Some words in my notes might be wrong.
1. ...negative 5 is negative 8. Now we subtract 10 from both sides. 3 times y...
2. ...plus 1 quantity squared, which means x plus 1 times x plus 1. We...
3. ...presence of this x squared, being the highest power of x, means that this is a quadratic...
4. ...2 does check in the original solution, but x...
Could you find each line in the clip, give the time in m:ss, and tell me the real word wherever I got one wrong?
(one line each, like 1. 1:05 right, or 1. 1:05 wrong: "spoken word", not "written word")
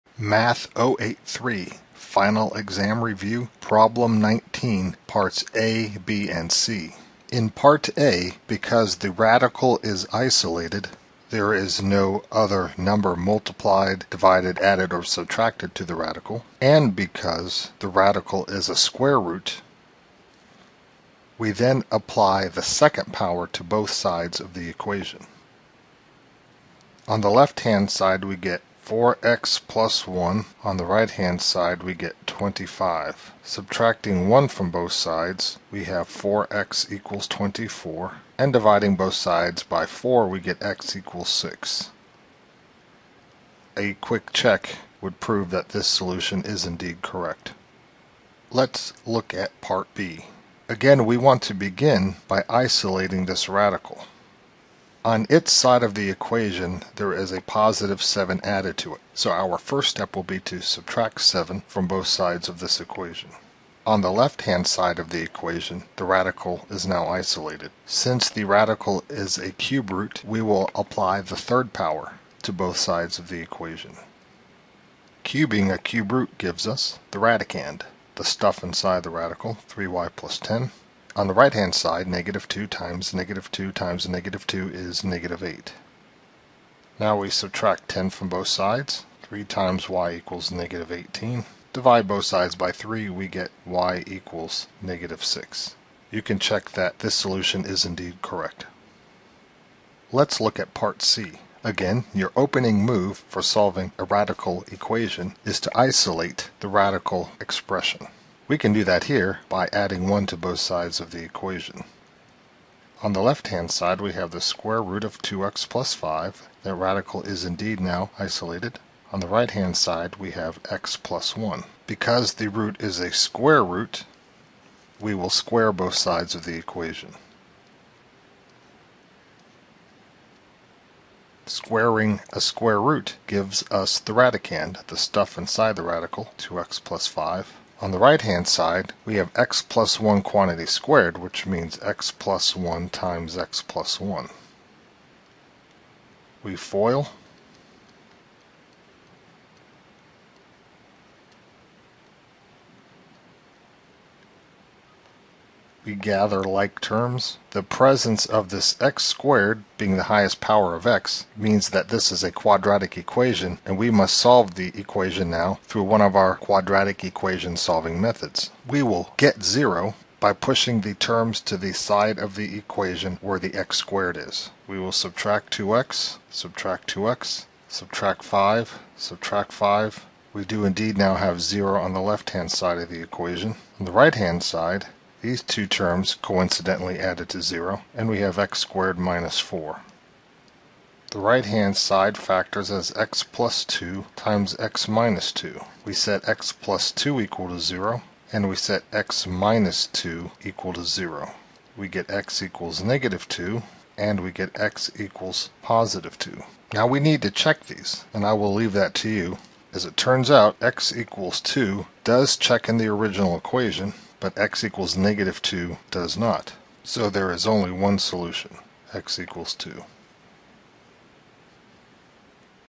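1. 1:24 wrong: "2", not "5"
2. 2:19 right
3. 2:37 right
4. 3:31 wrong: "equation", not "solution".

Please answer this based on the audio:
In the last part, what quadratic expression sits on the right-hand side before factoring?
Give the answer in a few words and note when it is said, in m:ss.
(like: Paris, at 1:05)
x^2 - 4, at 3:08.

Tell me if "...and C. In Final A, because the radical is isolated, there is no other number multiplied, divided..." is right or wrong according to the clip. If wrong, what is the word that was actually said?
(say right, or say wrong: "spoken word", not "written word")
wrong: "Part", not "Final".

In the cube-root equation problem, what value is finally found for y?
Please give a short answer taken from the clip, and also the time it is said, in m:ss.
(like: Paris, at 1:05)
-6, at 1:34.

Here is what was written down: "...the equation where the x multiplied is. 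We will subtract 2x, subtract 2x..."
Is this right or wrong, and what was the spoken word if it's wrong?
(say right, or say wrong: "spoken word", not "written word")
wrong: "squared", not "multiplied".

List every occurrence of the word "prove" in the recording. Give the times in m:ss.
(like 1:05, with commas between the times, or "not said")
0:45.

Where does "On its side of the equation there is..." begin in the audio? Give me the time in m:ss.
0:55.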